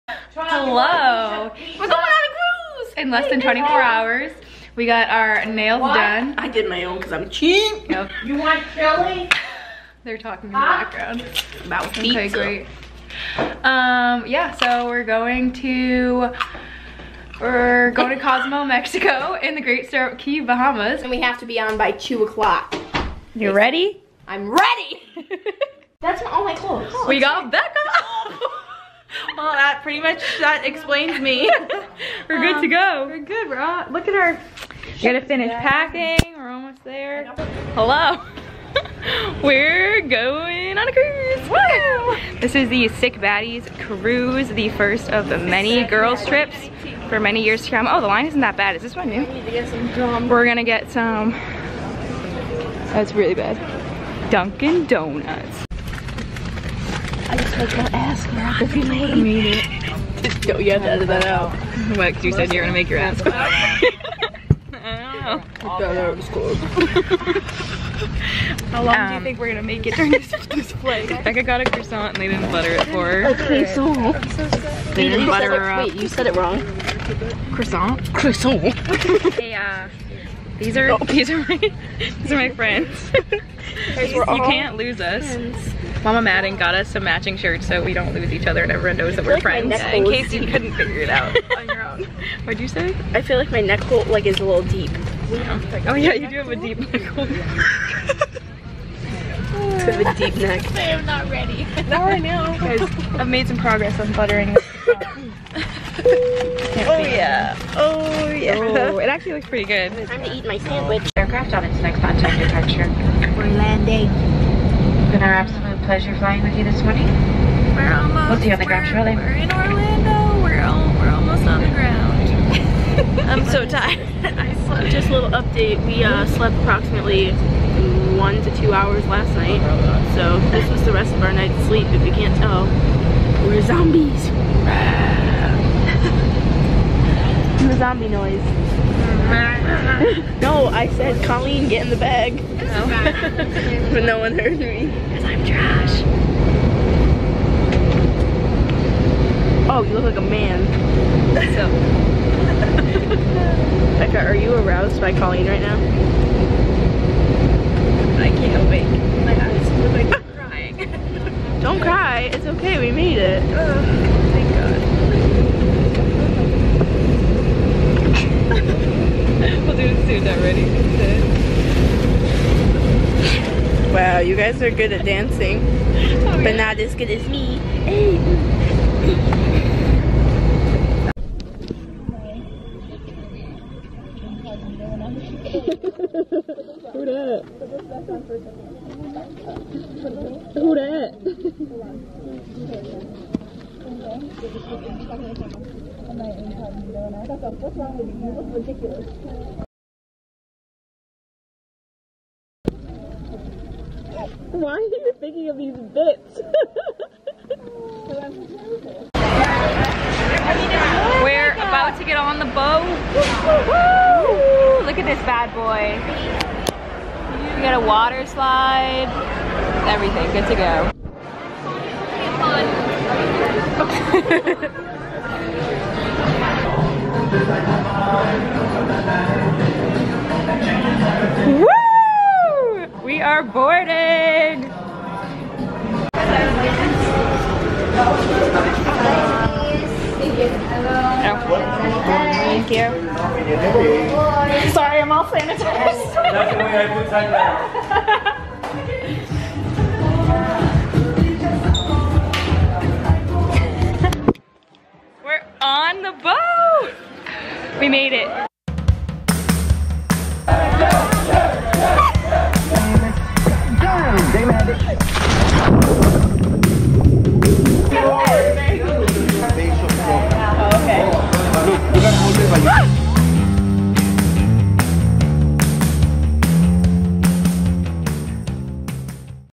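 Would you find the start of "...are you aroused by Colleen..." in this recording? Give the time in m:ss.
2:34.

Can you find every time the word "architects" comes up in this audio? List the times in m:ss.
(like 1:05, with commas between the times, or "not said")
not said.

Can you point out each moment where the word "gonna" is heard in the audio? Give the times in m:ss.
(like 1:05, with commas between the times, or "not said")
0:50, 1:09.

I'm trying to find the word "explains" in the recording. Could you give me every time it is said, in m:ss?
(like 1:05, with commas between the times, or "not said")
0:30.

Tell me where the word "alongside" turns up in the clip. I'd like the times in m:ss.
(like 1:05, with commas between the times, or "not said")
not said.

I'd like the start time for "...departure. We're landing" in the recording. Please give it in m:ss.
1:52.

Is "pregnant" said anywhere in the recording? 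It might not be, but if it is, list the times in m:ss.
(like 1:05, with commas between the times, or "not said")
not said.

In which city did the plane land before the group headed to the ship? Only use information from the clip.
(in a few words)
Orlando.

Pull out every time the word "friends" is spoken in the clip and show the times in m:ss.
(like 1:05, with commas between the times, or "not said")
1:22, 1:29.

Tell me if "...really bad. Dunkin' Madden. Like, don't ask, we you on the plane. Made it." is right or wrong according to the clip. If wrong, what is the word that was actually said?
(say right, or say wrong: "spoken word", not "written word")
wrong: "Donuts", not "Madden".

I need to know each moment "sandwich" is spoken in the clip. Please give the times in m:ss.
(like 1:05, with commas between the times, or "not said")
1:50.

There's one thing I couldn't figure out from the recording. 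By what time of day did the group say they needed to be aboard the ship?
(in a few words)
2 o'clock.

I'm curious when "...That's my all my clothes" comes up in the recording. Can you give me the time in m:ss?
0:26.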